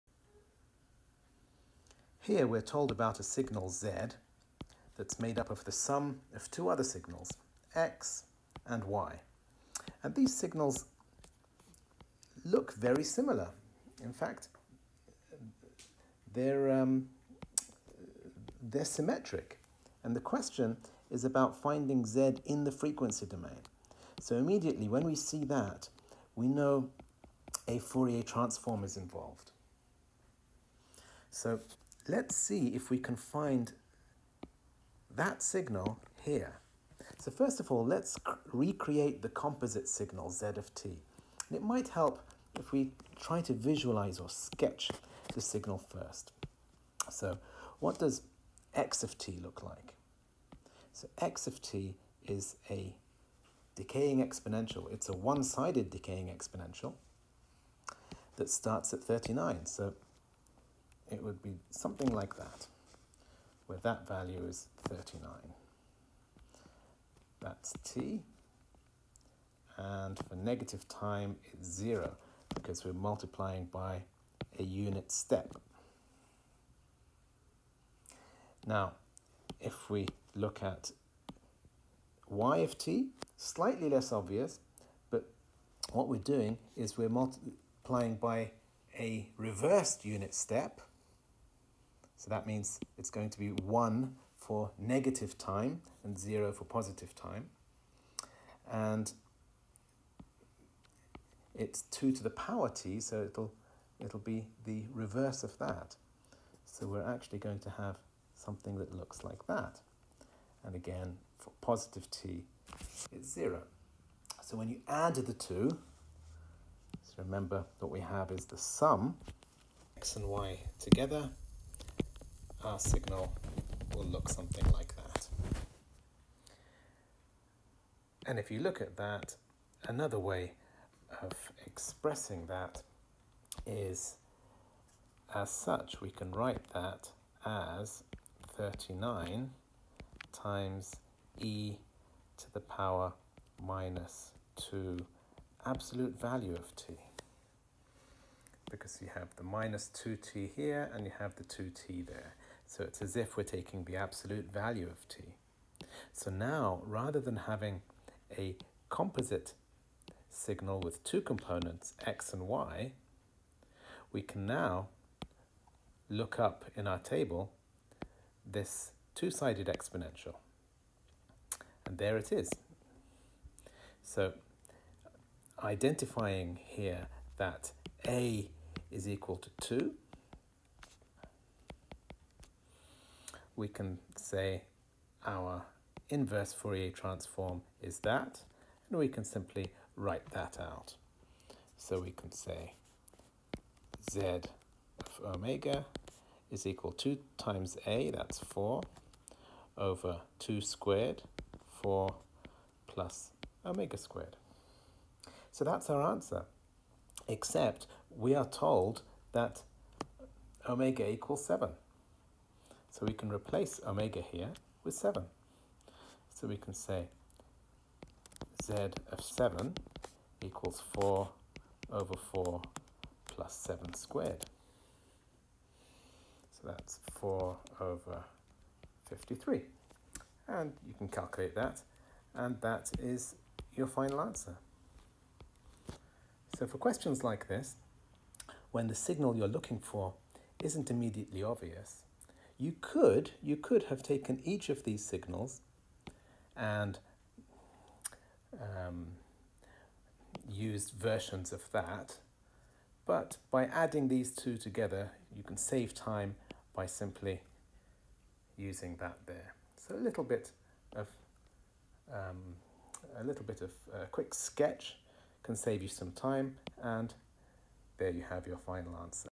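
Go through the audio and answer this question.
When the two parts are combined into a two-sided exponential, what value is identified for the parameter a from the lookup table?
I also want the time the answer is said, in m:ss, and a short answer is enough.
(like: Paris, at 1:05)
2, at 2:58.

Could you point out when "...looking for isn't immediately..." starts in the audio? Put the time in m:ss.
3:59.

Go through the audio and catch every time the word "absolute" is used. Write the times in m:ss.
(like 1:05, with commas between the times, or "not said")
2:25, 2:33.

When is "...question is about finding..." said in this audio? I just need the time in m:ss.
0:20.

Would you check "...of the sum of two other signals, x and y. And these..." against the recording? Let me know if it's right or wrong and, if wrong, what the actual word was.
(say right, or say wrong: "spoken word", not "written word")
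right.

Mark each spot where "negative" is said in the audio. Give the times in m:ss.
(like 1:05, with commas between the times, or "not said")
1:10, 1:34.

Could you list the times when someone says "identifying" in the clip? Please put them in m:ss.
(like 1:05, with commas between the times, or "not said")
2:55.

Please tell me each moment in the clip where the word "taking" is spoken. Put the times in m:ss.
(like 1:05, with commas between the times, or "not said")
2:33.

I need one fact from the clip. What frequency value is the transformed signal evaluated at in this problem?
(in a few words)
7.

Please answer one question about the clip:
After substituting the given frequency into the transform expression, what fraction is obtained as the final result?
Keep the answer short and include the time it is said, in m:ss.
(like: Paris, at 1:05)
4/53, at 3:47.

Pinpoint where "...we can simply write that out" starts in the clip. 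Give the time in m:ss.
3:08.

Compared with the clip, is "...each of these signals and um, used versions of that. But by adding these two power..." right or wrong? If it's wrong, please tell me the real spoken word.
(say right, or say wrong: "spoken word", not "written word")
wrong: "together", not "power".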